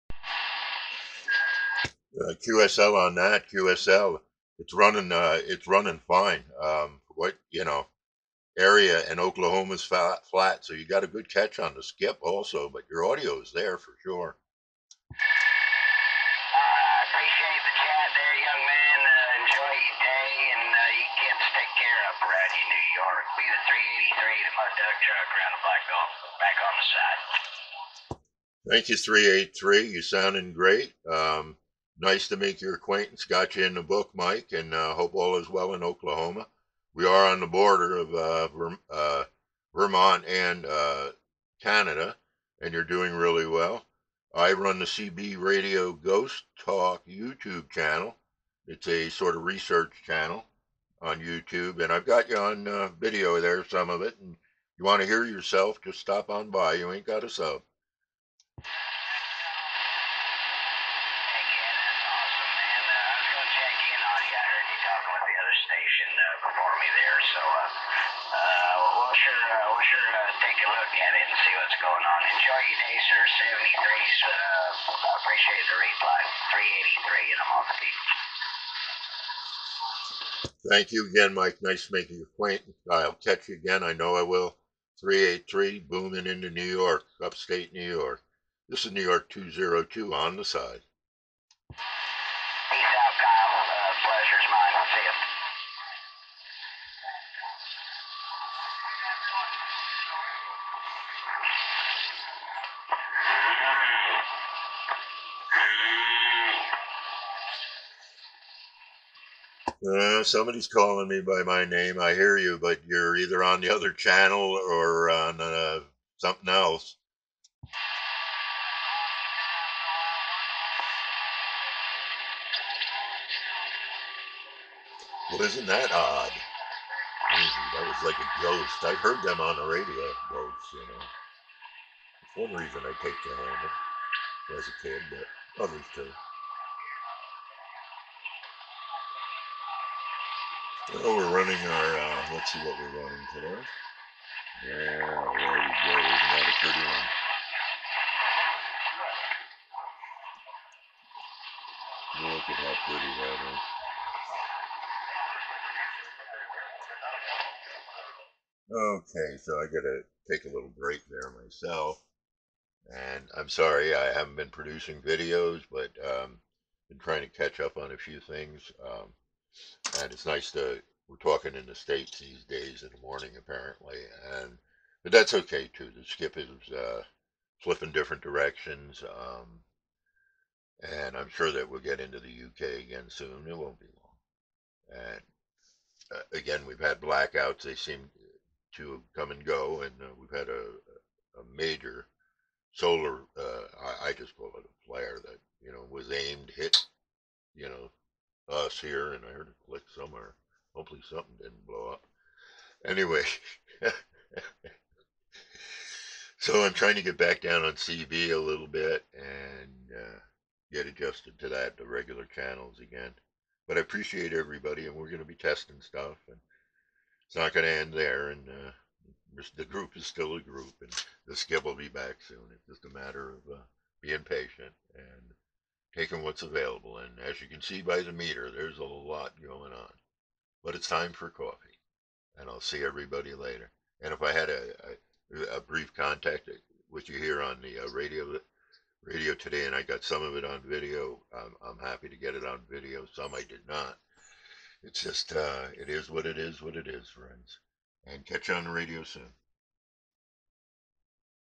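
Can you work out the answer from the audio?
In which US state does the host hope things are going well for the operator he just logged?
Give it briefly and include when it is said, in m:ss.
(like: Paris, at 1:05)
Oklahoma, at 0:35.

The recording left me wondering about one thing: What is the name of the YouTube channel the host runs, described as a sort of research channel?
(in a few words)
CB Radio Ghost Talk.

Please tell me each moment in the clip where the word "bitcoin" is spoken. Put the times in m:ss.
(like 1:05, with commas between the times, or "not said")
not said.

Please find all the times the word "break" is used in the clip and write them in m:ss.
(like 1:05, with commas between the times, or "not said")
2:40.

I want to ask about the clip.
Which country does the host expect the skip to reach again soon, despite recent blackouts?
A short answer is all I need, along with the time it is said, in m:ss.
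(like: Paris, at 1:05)
UK, at 3:02.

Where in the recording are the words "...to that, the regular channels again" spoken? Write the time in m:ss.
3:31.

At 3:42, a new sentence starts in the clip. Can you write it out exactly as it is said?
It's just a matter of uh, being patient and taking what's available.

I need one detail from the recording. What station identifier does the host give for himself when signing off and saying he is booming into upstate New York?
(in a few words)
New York 202.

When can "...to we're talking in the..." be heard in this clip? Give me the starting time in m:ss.
2:50.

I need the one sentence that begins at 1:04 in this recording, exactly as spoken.
talking with the other station uh, before me there.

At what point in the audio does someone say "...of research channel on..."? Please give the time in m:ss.
0:49.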